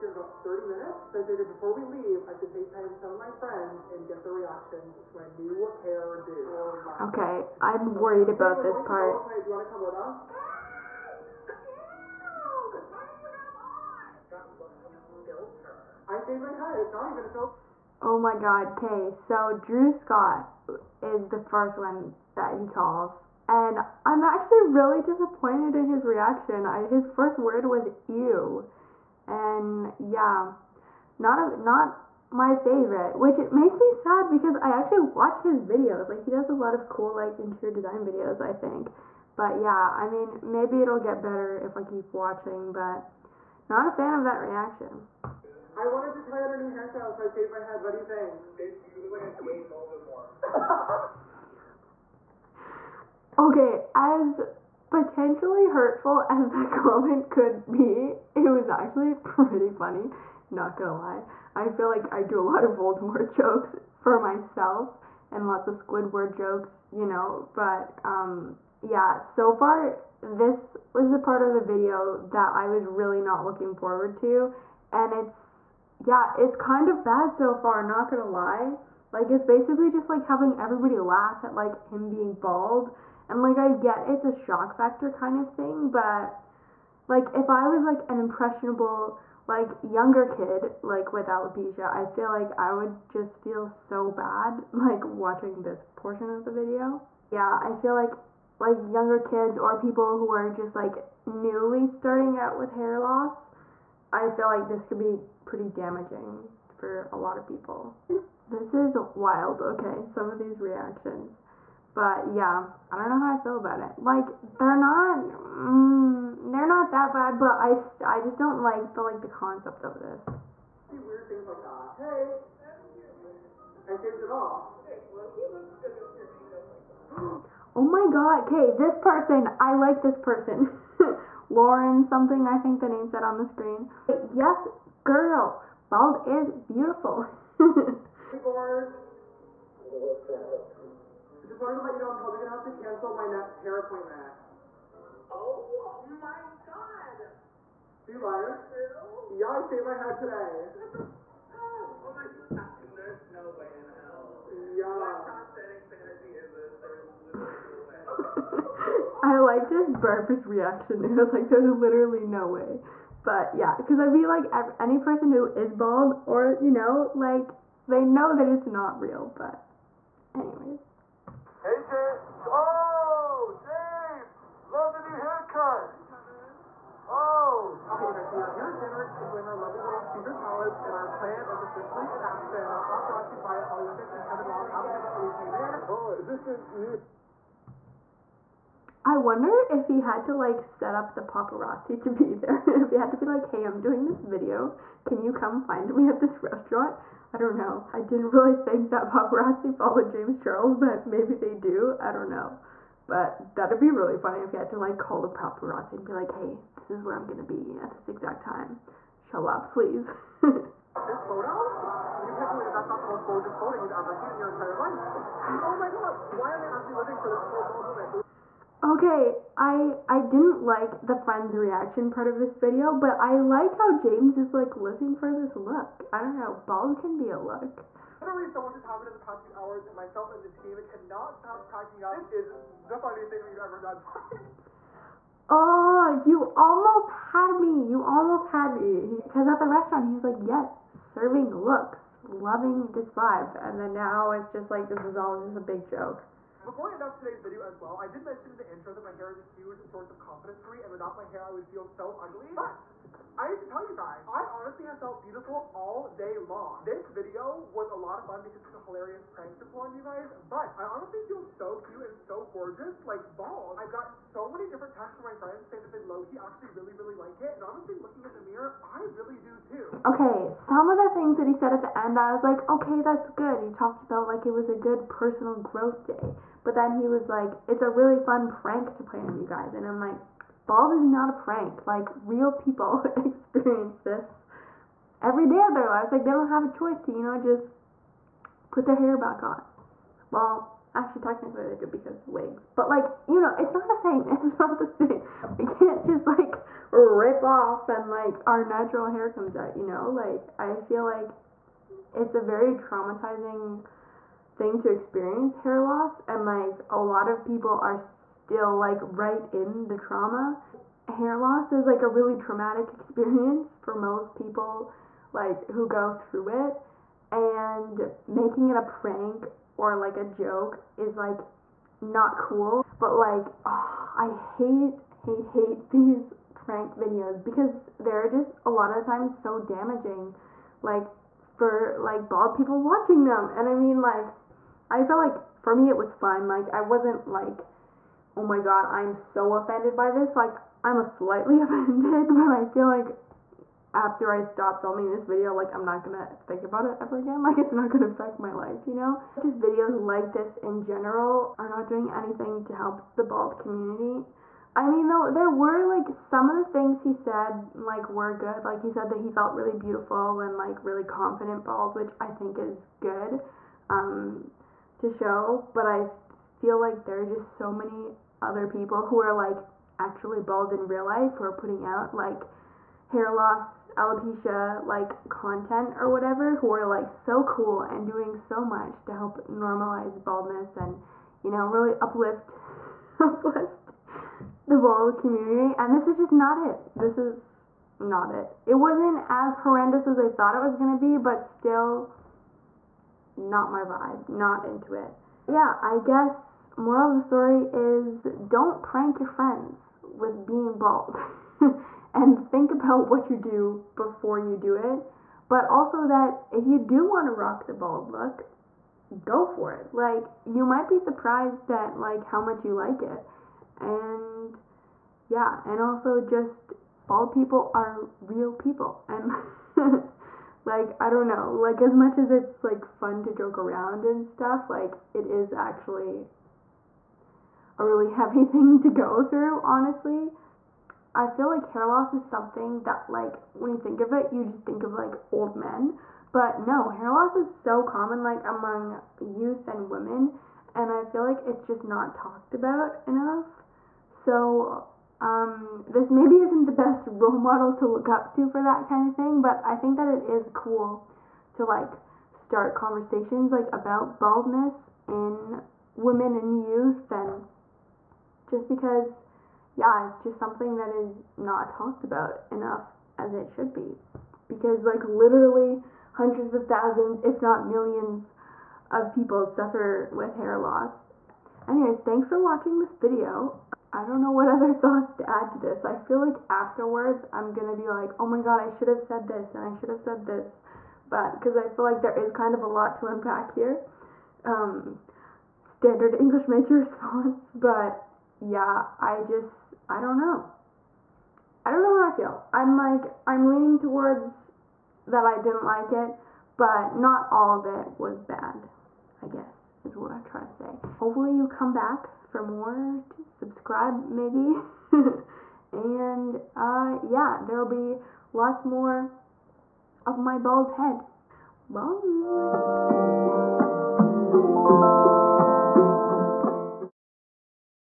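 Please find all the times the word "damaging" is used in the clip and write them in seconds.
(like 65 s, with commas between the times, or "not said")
105 s, 329 s.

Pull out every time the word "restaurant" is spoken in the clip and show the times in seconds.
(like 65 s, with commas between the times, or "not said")
196 s, 239 s.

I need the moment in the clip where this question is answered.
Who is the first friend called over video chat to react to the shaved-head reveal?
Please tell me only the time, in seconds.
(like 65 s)
19 s.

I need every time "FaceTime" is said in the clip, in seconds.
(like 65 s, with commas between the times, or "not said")
2 s.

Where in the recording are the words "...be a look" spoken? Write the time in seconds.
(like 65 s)
227 s.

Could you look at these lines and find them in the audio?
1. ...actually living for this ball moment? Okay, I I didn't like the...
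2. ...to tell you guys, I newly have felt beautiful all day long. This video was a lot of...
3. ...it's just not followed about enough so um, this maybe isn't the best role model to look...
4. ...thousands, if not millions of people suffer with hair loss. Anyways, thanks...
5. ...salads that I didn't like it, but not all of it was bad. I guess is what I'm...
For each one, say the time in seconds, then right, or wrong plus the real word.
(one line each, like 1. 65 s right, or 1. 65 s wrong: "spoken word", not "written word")
1. 216 s right
2. 253 s wrong: "honestly", not "newly"
3. 441 s wrong: "talked", not "followed"
4. 466 s right
5. 493 s wrong: "towards", not "salads".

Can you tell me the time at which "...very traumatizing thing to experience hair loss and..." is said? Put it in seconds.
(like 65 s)
302 s.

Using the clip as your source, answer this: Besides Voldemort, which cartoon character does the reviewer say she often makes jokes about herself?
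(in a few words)
Squidward.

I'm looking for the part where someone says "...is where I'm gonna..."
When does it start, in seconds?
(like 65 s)
206 s.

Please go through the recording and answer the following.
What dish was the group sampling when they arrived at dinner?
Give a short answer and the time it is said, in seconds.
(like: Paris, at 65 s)
Caesar salads, at 180 s.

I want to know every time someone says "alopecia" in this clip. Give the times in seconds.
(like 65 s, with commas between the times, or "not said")
91 s, 373 s.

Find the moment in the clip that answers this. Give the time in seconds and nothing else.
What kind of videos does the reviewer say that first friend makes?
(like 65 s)
37 s.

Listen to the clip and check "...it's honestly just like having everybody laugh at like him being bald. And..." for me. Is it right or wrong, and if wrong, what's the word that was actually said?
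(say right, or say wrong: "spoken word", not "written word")
wrong: "basically", not "honestly".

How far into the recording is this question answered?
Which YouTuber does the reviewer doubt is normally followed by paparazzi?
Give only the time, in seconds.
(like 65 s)
200 s.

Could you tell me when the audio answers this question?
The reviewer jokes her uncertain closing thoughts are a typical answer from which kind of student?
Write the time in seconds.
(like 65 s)
486 s.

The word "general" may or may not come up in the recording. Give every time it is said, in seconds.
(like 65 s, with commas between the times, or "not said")
350 s.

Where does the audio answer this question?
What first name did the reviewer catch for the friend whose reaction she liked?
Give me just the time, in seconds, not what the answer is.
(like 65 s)
131 s.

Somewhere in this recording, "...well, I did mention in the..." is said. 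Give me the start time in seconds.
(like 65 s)
247 s.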